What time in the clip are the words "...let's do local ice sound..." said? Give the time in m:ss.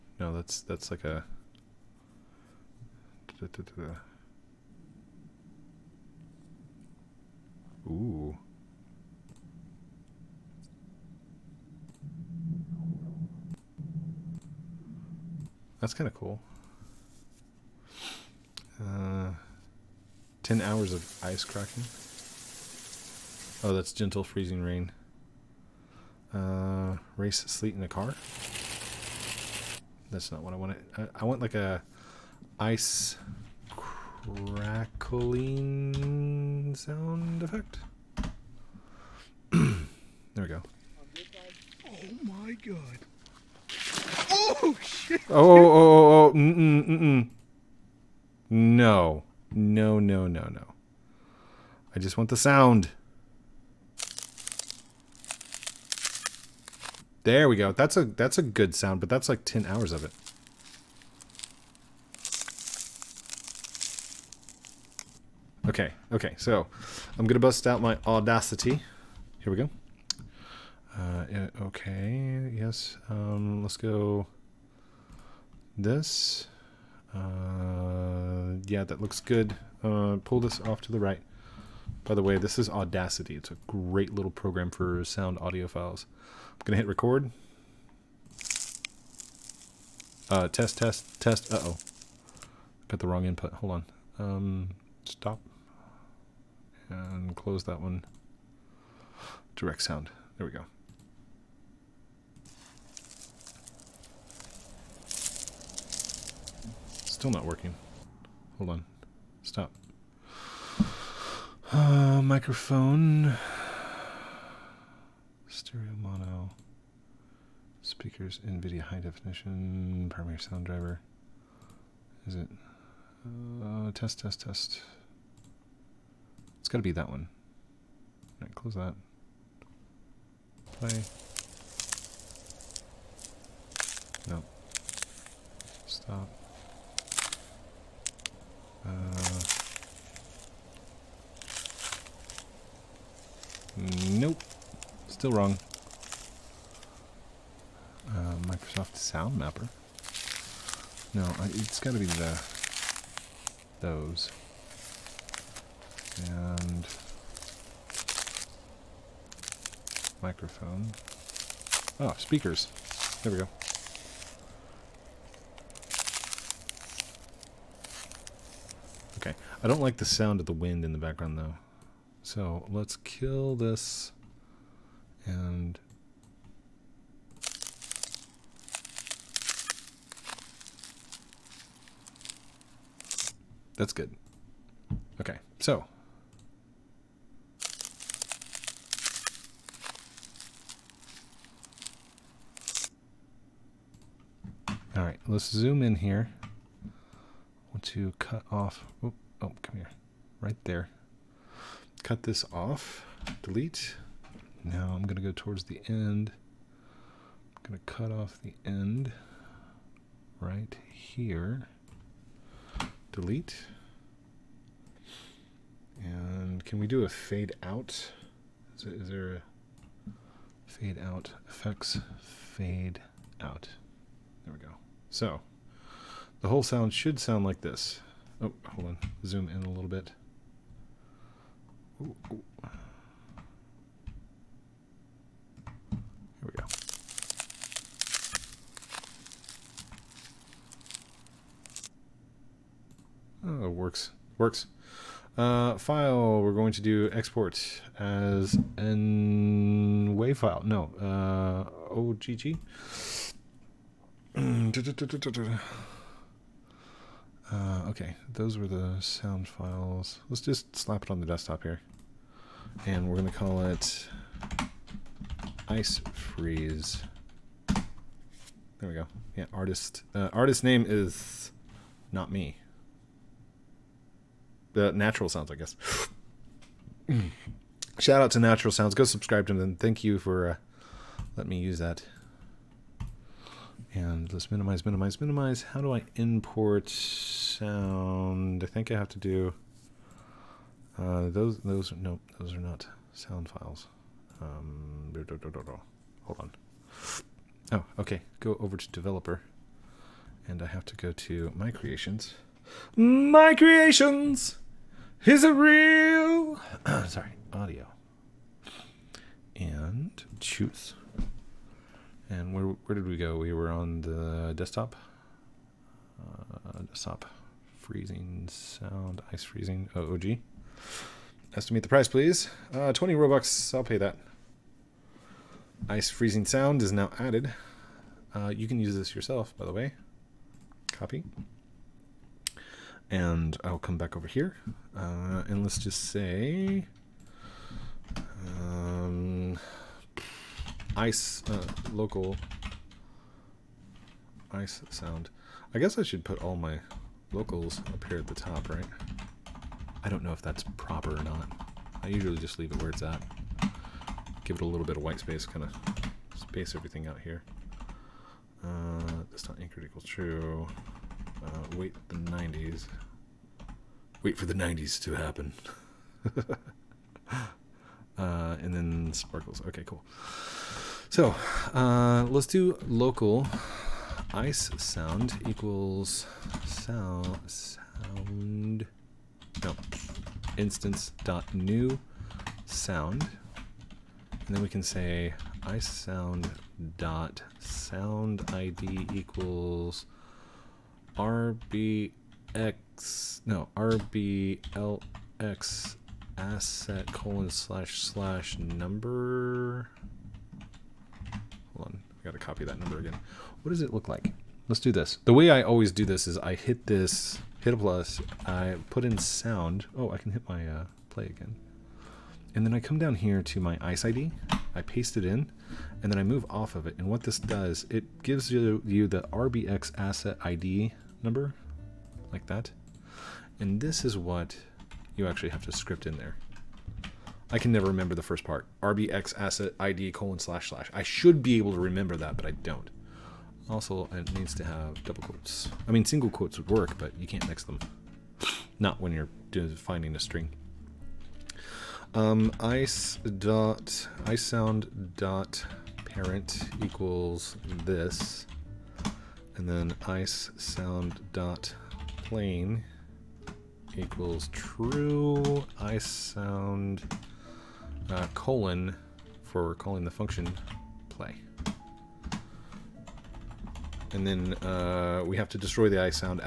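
6:12.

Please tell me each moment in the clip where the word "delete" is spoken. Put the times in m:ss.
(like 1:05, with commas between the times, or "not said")
3:23, 3:33.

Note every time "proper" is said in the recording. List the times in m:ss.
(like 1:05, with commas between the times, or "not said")
5:50.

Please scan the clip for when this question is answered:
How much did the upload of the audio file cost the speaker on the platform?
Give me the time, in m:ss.
5:22.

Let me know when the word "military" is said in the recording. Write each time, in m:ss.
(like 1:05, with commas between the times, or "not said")
not said.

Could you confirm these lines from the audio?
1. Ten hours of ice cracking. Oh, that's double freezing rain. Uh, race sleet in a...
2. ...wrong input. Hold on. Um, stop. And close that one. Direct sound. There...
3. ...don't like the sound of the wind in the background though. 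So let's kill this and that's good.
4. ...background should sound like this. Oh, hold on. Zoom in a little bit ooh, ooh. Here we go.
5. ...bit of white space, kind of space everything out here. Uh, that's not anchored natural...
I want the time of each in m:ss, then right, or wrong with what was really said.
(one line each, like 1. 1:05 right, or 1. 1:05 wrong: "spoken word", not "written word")
1. 0:20 wrong: "gentle", not "double"
2. 1:33 right
3. 2:49 right
4. 3:46 wrong: "sound", not "background"
5. 5:54 wrong: "equal", not "natural".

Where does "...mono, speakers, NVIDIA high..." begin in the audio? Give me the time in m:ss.
1:56.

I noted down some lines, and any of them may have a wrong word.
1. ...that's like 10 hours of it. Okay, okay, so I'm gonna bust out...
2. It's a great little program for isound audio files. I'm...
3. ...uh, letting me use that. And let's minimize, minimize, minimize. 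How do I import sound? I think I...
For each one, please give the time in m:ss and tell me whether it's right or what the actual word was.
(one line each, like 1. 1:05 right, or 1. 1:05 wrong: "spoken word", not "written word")
1. 0:59 right
2. 1:23 wrong: "sound", not "isound"
3. 4:40 right.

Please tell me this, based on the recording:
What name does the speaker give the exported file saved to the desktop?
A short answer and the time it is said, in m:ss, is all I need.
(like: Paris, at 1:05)
ice freeze, at 4:25.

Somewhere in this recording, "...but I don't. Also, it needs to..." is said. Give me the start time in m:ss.
7:12.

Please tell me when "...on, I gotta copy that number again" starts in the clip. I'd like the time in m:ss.
6:41.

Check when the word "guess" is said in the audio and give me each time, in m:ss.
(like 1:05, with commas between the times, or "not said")
4:35, 5:45.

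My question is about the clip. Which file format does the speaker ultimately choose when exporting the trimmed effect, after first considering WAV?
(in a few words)
OGG.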